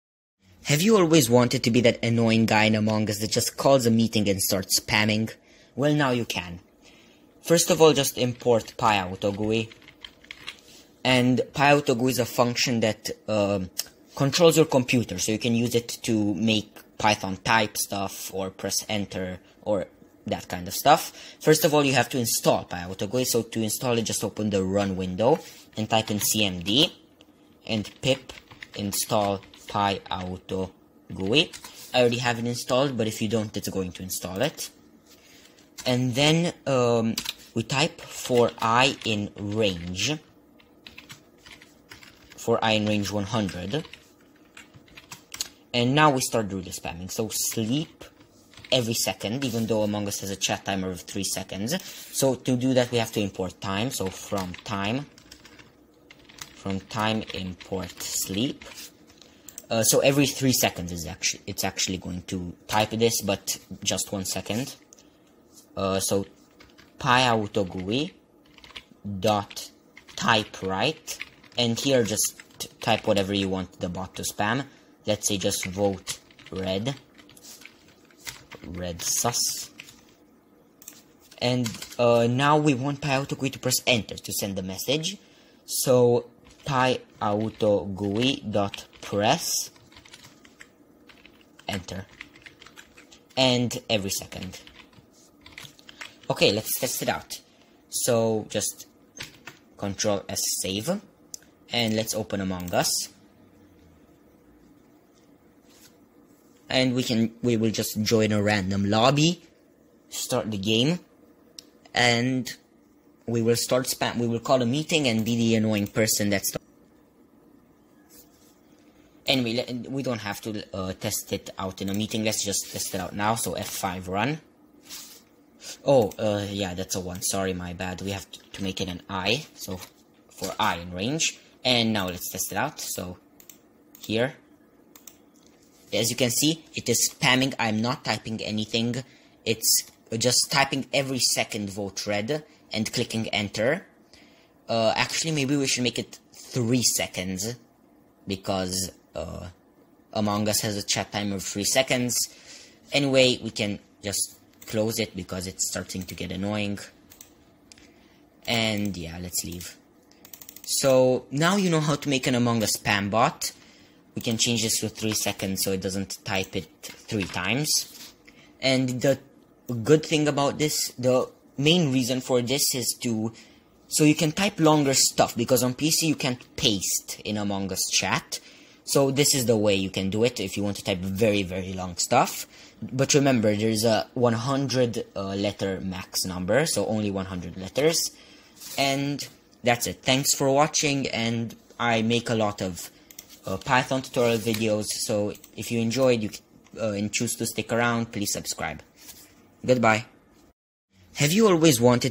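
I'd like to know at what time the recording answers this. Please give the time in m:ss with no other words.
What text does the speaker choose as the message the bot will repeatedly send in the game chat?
1:15.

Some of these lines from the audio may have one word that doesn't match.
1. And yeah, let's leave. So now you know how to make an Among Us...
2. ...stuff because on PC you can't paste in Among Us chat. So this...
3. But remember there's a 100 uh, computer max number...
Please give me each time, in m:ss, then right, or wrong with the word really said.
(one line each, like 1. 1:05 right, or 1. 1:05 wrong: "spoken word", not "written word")
1. 2:38 right
2. 2:54 right
3. 3:02 wrong: "letter", not "computer".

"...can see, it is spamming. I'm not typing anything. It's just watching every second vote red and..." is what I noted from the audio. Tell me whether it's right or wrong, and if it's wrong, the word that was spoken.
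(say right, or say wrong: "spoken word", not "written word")
wrong: "typing", not "watching".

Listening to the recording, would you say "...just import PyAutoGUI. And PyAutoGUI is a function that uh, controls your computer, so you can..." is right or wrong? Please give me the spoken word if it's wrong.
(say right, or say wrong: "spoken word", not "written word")
right.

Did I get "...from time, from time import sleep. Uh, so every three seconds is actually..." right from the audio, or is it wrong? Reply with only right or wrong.
right.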